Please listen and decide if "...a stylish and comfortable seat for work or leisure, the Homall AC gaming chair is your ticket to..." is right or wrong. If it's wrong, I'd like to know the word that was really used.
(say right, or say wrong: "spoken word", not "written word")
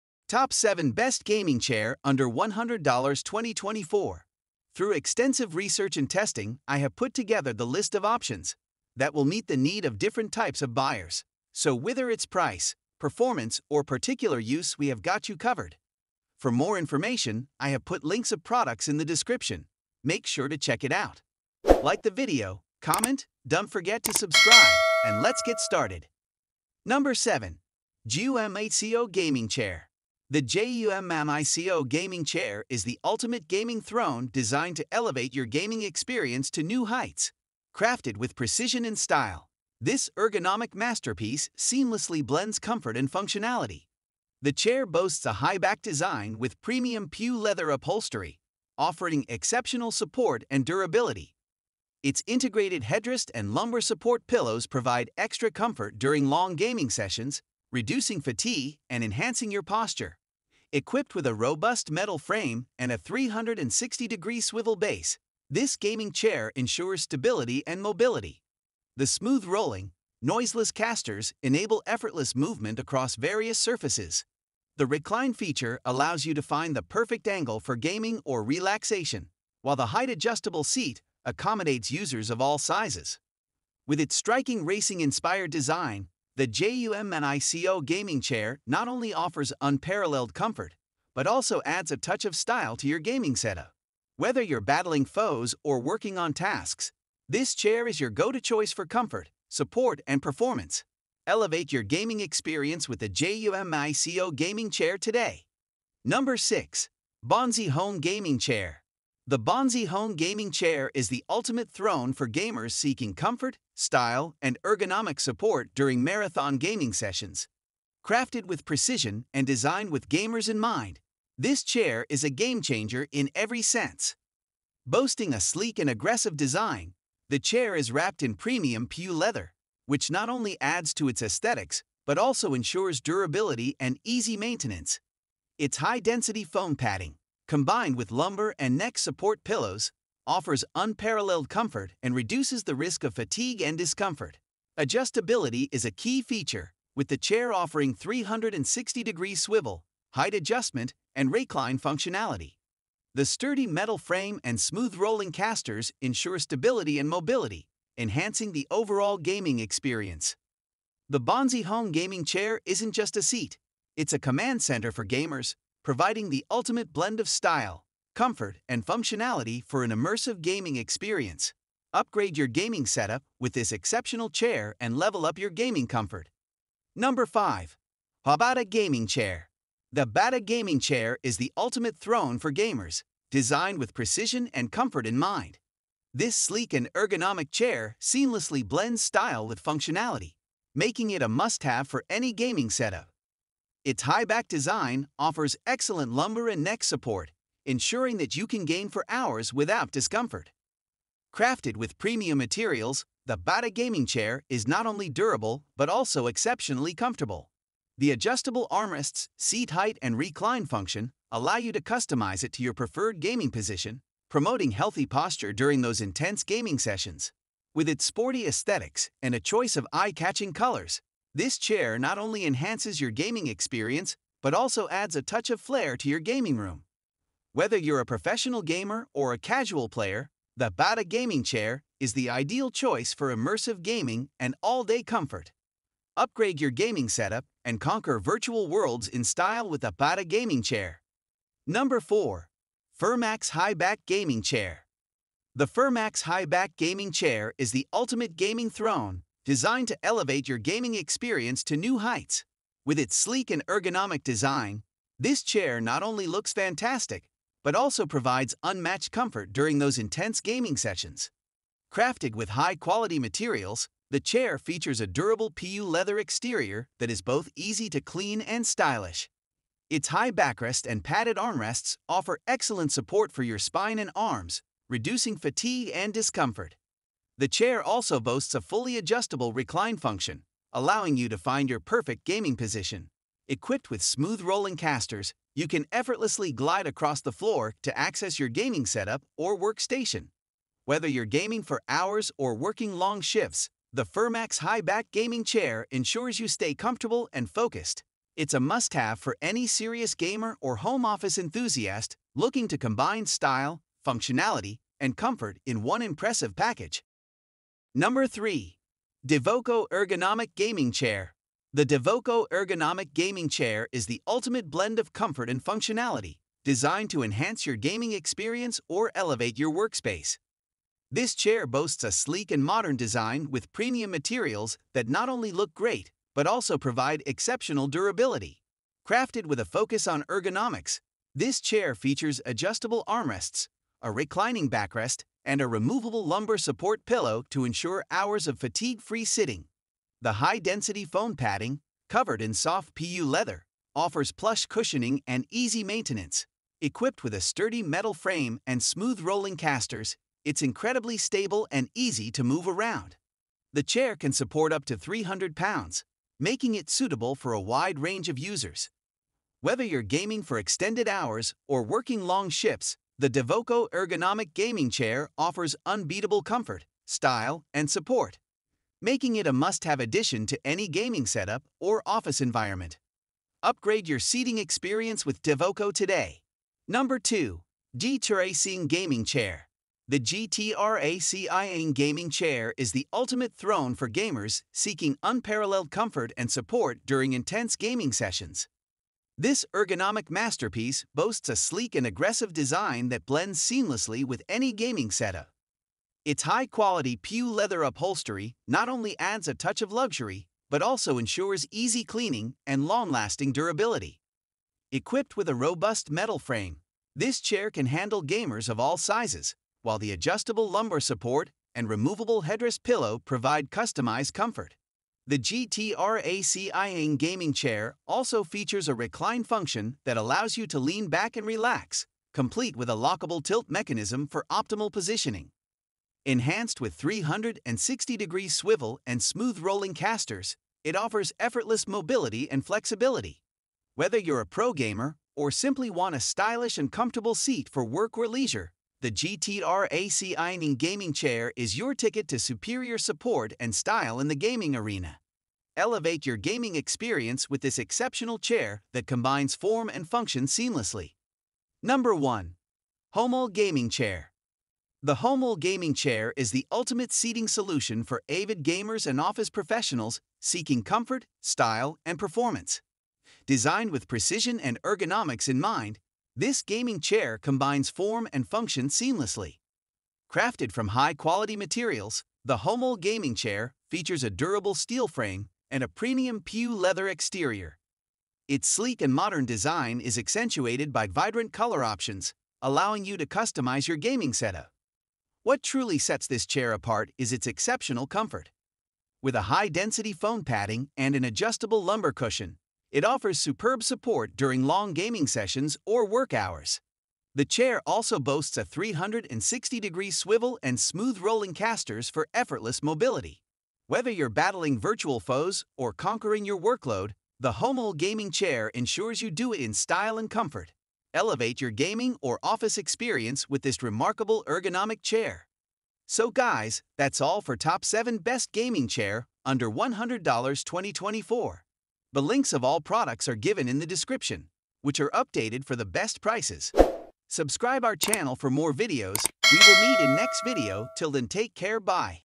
wrong: "GTR", not "Homall".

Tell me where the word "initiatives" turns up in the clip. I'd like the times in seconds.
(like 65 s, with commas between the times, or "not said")
not said.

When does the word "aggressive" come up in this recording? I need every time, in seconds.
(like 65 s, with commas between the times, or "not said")
125 s, 392 s.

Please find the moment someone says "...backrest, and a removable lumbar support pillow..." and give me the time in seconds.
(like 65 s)
334 s.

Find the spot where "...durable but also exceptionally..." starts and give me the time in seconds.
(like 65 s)
205 s.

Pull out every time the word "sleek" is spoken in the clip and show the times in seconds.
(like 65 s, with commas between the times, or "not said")
125 s, 186 s, 253 s, 322 s, 391 s, 478 s.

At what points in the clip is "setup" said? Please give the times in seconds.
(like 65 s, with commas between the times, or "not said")
93 s, 172 s, 192 s, 237 s, 288 s, 371 s, 395 s, 484 s.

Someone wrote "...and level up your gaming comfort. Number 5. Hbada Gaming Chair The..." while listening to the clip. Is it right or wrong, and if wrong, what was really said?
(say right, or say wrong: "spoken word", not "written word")
right.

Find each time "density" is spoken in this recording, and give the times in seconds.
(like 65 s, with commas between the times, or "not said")
135 s, 340 s, 489 s.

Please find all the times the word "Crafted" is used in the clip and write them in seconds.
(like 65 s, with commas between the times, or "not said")
37 s, 118 s, 201 s, 261 s, 329 s, 470 s.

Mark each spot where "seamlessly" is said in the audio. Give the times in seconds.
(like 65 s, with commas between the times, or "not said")
41 s, 188 s, 393 s, 450 s, 468 s.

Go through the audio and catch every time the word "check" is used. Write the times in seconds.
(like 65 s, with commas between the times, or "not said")
20 s.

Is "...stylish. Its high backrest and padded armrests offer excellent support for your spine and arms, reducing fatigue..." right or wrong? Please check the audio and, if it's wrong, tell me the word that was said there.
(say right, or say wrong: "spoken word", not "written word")
right.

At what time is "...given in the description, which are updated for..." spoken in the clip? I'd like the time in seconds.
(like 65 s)
523 s.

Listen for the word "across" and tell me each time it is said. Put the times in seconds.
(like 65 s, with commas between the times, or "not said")
72 s, 286 s.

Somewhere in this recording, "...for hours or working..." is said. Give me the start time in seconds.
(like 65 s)
291 s.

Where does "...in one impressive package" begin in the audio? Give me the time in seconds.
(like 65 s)
305 s.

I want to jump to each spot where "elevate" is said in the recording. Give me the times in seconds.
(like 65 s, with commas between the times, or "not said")
34 s, 101 s, 250 s, 319 s, 445 s, 511 s.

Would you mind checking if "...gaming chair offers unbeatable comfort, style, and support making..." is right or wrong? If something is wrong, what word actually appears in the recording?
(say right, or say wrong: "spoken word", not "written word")
right.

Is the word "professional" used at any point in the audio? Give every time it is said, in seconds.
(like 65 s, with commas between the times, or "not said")
228 s, 459 s.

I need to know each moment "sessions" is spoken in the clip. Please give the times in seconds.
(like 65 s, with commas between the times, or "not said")
56 s, 116 s, 216 s, 260 s, 388 s, 495 s.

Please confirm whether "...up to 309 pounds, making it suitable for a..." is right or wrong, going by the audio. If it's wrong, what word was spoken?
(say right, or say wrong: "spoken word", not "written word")
wrong: "300", not "309".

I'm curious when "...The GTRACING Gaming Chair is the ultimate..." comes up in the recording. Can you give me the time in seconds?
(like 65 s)
380 s.